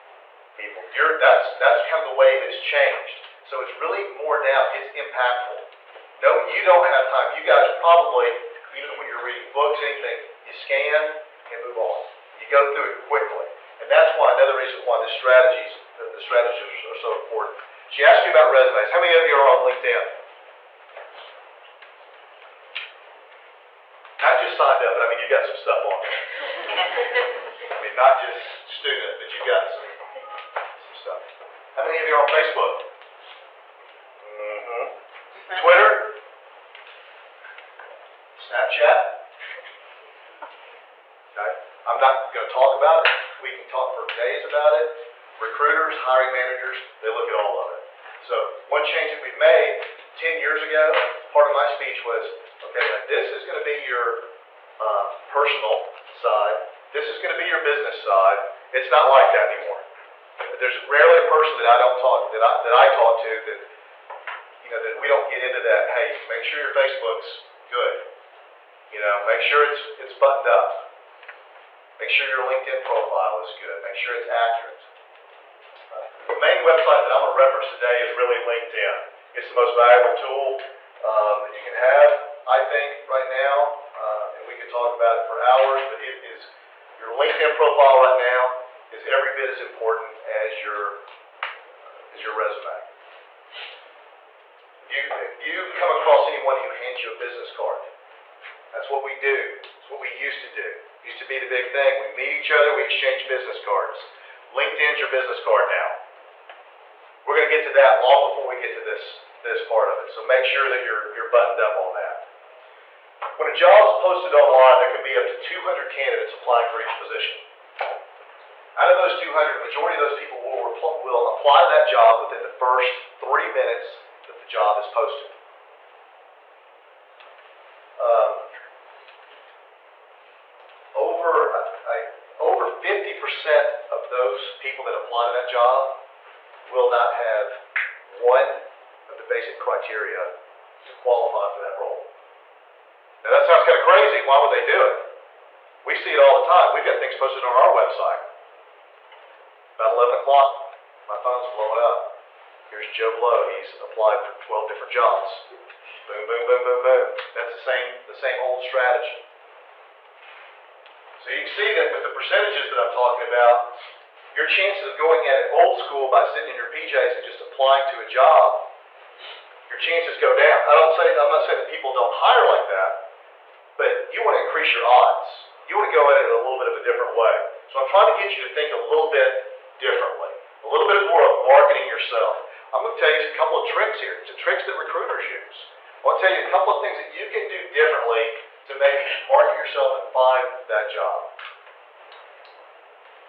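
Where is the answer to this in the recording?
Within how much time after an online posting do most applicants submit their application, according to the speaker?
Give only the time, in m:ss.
2:02.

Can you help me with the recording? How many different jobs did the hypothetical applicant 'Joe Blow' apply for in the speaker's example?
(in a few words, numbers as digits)
12.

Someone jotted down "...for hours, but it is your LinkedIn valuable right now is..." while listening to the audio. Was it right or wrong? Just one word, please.
wrong.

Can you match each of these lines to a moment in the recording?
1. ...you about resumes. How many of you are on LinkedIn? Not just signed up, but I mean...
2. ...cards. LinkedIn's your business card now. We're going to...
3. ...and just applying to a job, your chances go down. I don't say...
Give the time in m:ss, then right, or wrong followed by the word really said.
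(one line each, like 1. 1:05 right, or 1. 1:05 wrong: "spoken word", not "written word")
1. 0:18 right
2. 1:43 right
3. 2:47 right.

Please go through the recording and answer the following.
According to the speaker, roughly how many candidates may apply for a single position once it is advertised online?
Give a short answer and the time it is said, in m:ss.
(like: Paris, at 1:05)
200, at 1:55.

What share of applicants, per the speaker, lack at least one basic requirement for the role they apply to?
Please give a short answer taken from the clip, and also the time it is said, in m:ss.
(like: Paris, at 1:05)
over 50%, at 2:12.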